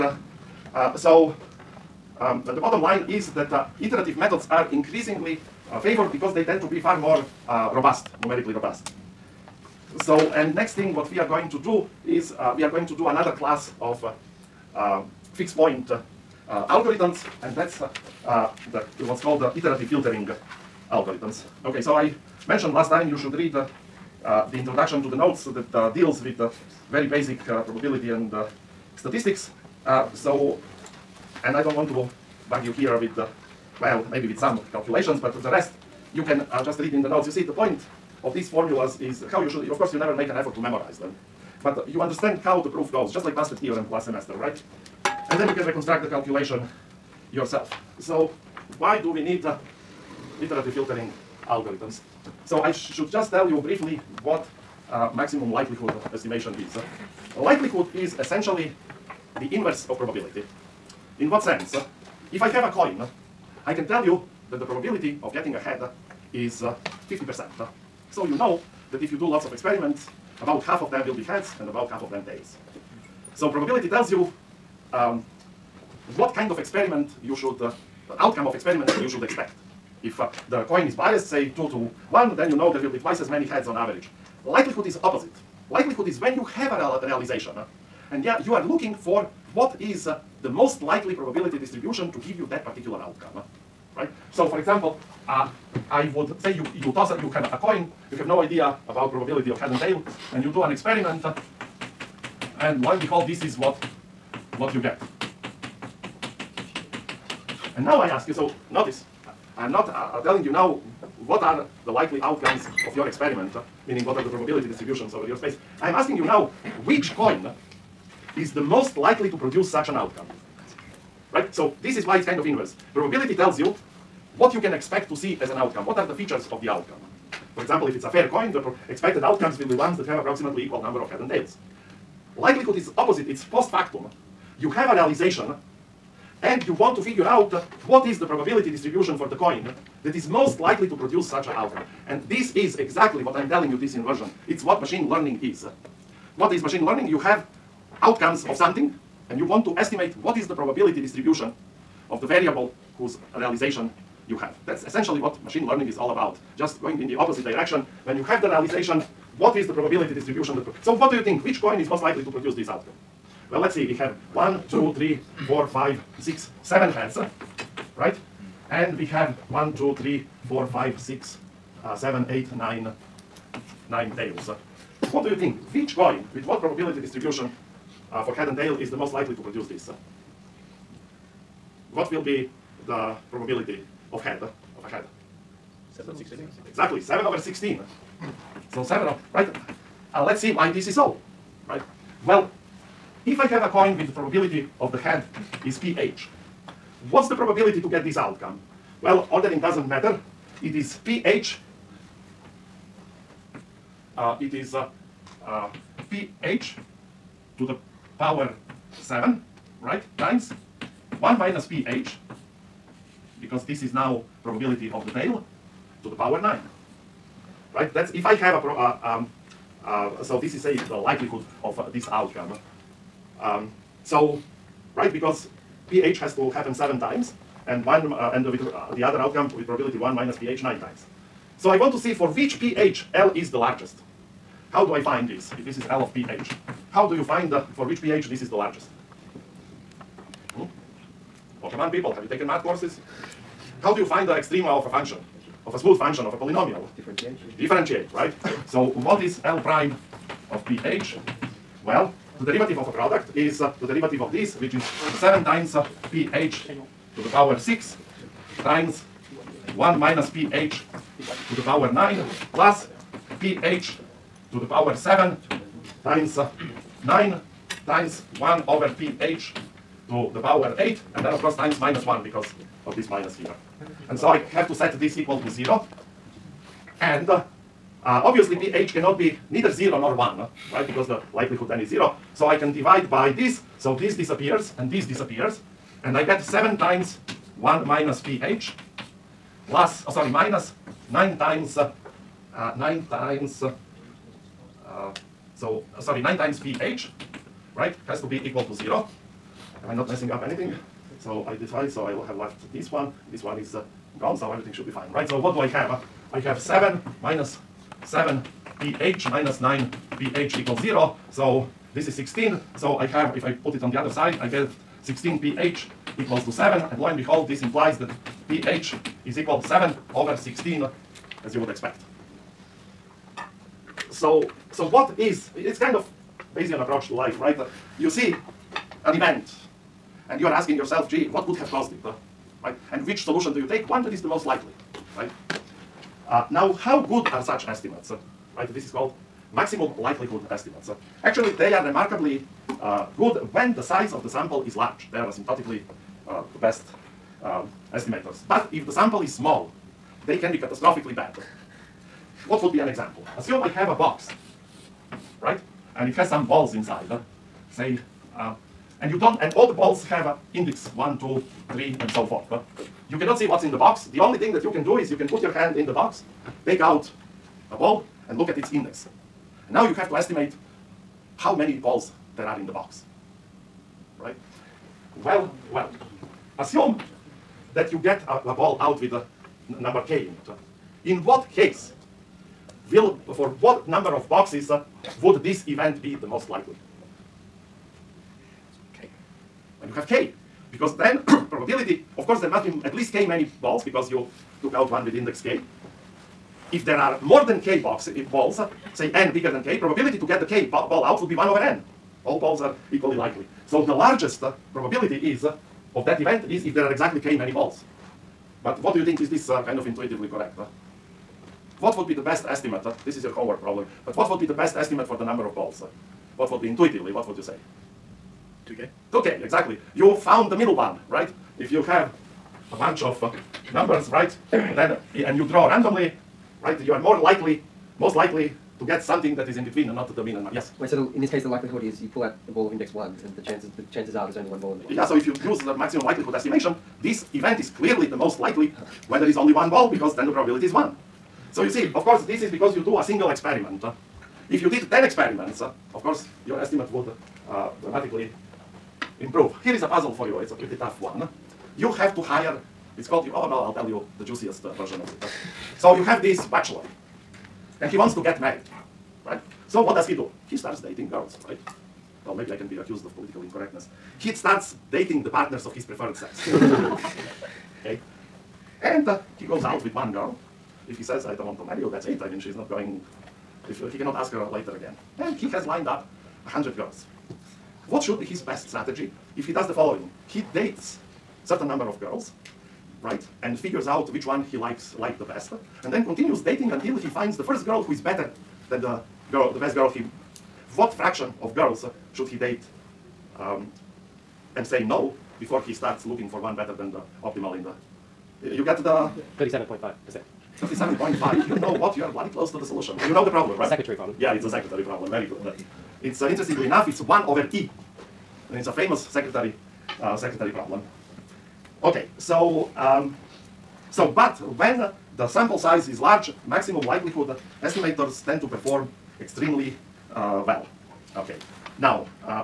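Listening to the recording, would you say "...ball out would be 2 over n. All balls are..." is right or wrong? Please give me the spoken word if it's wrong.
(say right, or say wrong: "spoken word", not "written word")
wrong: "1", not "2".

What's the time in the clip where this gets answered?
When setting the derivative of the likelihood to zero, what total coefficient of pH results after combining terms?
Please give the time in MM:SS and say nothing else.
05:11.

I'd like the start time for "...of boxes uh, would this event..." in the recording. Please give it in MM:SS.
06:24.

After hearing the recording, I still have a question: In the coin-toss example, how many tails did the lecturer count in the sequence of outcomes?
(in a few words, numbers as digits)
9.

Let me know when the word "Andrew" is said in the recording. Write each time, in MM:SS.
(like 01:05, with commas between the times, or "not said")
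not said.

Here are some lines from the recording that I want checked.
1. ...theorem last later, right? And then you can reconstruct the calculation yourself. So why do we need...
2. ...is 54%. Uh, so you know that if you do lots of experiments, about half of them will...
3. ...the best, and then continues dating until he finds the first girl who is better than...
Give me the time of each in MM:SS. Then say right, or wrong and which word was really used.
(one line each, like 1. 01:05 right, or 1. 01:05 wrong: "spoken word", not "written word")
1. 00:43 wrong: "semester", not "later"
2. 01:06 wrong: "50", not "54"
3. 08:05 right.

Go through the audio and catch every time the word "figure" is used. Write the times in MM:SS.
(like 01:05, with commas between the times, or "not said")
02:16, 08:03.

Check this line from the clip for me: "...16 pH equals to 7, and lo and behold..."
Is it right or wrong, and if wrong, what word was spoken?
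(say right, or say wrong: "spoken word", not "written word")
right.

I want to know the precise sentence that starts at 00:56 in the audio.
Uh, likelihood is essentially the inverse of probability.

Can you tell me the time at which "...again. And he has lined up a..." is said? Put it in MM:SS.
07:54.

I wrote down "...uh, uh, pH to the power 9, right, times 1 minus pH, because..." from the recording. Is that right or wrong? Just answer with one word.
wrong.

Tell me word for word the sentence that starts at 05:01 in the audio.
So I decide, so I will have left this one, this one is uh, gone, so everything should be fine, right?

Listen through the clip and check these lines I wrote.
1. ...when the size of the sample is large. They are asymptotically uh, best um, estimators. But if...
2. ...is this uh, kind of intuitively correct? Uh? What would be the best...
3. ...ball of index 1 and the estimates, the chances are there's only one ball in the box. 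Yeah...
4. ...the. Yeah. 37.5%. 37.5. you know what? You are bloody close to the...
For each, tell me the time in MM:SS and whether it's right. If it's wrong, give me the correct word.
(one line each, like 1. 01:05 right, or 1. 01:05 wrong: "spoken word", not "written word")
1. 05:43 right
2. 06:49 right
3. 07:12 wrong: "chances", not "estimates"
4. 08:18 right.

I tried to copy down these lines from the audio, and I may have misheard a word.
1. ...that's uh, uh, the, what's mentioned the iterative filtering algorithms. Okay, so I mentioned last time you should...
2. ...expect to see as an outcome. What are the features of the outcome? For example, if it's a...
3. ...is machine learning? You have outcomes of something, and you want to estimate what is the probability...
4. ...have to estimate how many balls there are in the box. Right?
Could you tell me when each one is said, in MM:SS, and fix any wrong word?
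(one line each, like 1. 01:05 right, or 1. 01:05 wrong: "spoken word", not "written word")
1. 00:17 wrong: "called", not "mentioned"
2. 02:04 right
3. 02:26 right
4. 06:09 right.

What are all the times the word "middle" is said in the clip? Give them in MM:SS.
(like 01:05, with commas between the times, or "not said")
07:00.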